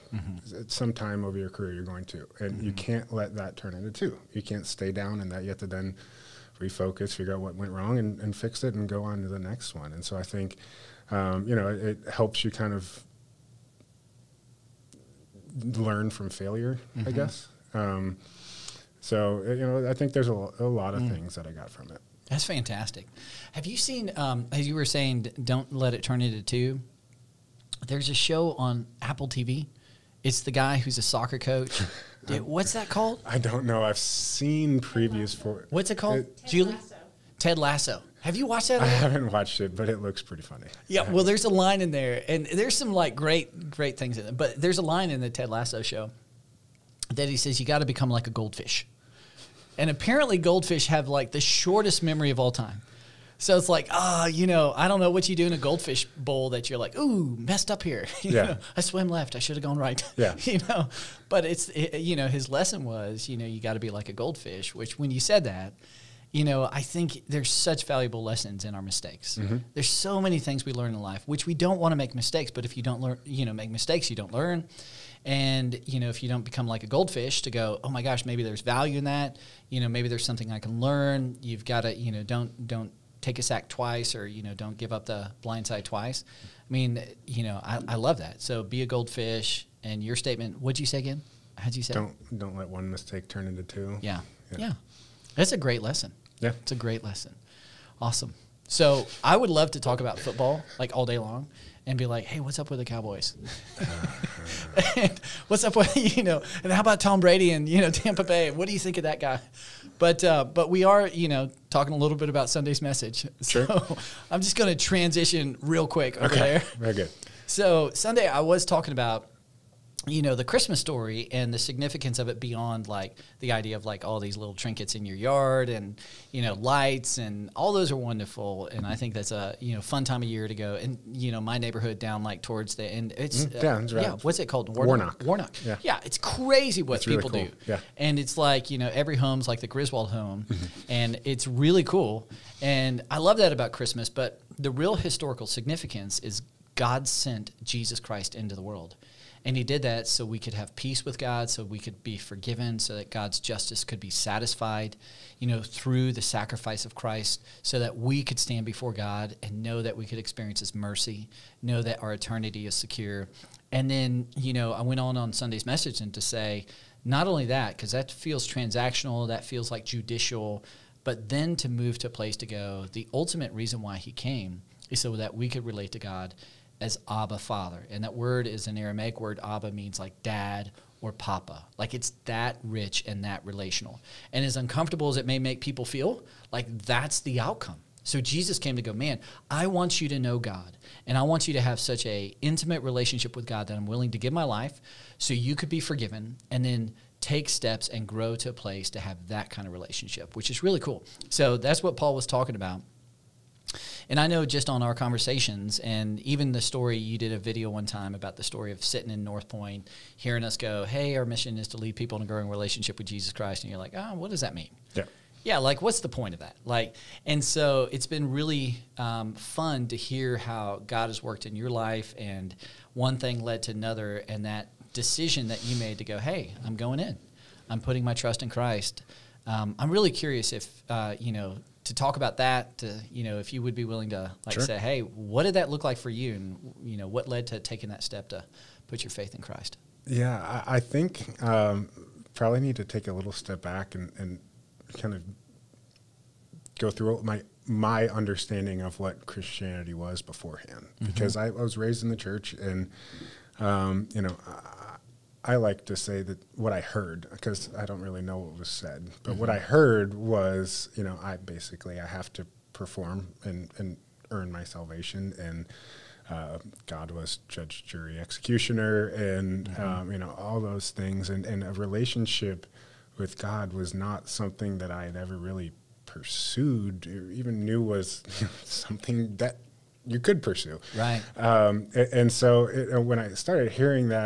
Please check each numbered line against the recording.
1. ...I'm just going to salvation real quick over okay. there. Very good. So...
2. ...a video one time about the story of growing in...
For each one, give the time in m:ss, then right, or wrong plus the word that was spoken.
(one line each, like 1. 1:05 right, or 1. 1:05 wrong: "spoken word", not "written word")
1. 1:54 wrong: "transition", not "salvation"
2. 3:27 wrong: "sitting", not "growing".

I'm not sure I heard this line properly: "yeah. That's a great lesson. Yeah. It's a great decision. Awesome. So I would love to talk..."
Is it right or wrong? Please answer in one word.
wrong.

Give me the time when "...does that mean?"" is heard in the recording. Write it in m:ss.
3:34.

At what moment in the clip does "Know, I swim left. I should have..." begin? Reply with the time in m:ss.
0:58.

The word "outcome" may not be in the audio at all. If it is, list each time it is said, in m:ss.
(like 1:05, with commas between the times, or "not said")
3:07.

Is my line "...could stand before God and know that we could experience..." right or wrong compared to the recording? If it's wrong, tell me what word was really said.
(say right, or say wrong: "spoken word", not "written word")
right.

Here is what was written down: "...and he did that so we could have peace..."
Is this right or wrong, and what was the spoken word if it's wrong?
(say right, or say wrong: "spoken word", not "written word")
right.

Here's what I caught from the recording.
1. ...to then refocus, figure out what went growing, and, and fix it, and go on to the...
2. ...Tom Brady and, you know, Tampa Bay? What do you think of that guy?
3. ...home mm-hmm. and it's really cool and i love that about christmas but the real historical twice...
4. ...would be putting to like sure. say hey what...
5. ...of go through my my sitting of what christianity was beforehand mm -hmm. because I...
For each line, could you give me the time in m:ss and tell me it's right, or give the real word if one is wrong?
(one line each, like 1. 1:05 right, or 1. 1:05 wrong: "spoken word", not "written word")
1. 0:05 wrong: "wrong", not "growing"
2. 1:46 right
3. 2:20 wrong: "significance", not "twice"
4. 3:53 wrong: "willing", not "putting"
5. 4:05 wrong: "understanding", not "sitting".